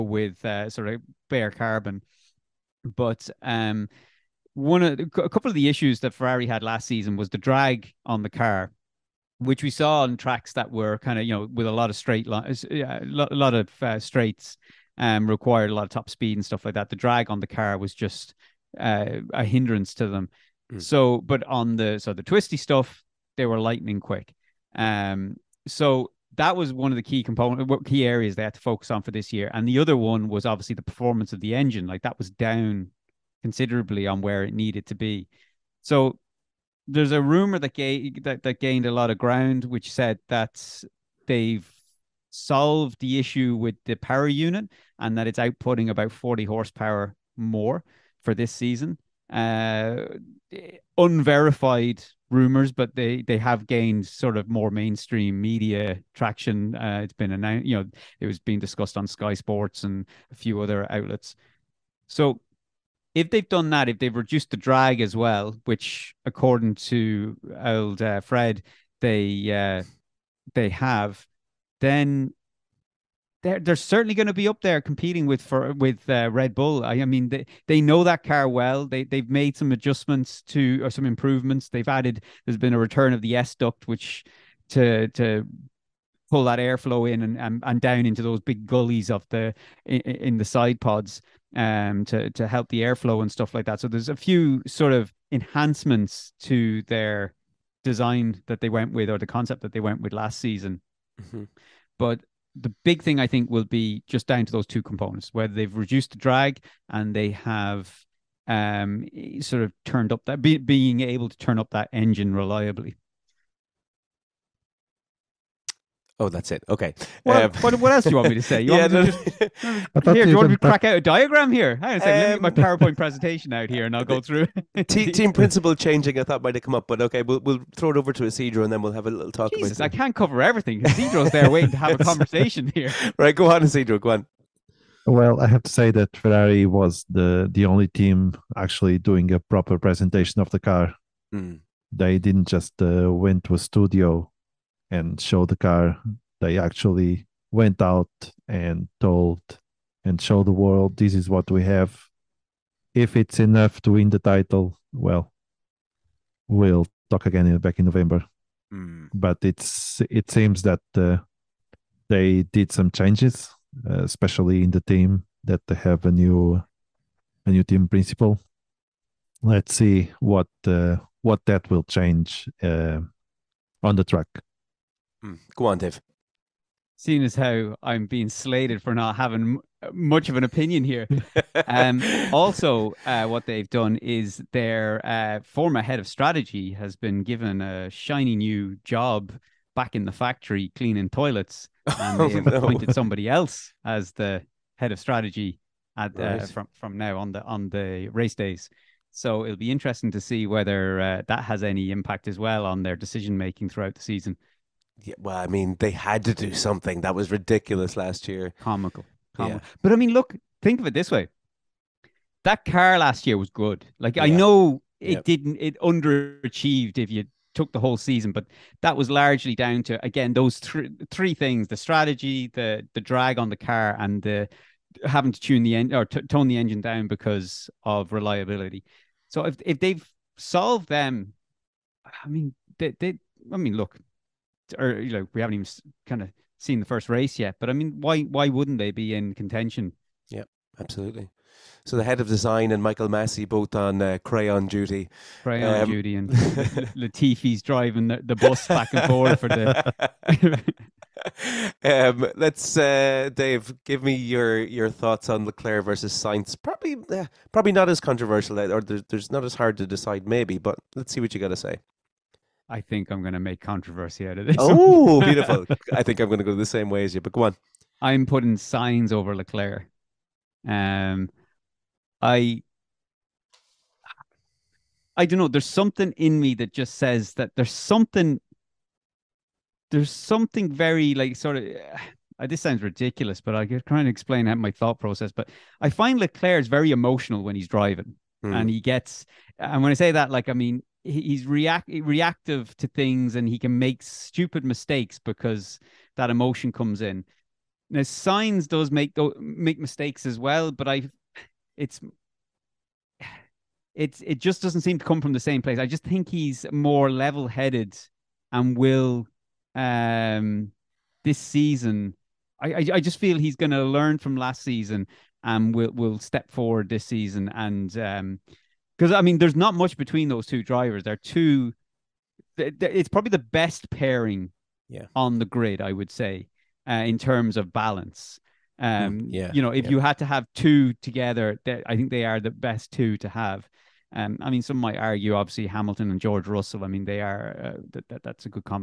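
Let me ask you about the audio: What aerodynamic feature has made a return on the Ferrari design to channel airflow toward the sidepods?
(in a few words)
S duct.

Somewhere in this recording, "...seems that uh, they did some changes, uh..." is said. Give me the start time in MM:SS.
02:40.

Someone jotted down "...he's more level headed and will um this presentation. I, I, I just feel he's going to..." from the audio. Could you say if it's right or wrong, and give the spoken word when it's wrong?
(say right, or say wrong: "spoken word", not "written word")
wrong: "season", not "presentation".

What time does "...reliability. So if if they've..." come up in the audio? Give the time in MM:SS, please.
03:48.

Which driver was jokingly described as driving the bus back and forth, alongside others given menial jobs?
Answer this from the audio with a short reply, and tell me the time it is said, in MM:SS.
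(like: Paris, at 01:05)
Latifi, at 04:06.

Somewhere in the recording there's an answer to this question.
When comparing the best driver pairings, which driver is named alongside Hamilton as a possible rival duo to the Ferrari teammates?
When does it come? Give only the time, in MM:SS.
05:36.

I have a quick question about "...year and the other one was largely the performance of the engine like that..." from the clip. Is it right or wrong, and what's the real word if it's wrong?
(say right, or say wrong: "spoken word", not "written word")
wrong: "obviously", not "largely".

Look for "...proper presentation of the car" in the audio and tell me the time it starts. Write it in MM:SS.
02:19.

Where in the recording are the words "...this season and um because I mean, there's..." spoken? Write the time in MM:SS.
05:16.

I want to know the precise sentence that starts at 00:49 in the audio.
Uh, unverified rumors, but they they have gained sort of more mainstream media traction.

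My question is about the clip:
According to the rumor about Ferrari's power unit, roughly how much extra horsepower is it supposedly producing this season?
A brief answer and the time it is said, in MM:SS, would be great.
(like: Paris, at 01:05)
40 horsepower, at 00:46.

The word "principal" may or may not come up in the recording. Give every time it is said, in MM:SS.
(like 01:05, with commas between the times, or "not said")
02:05, 02:47.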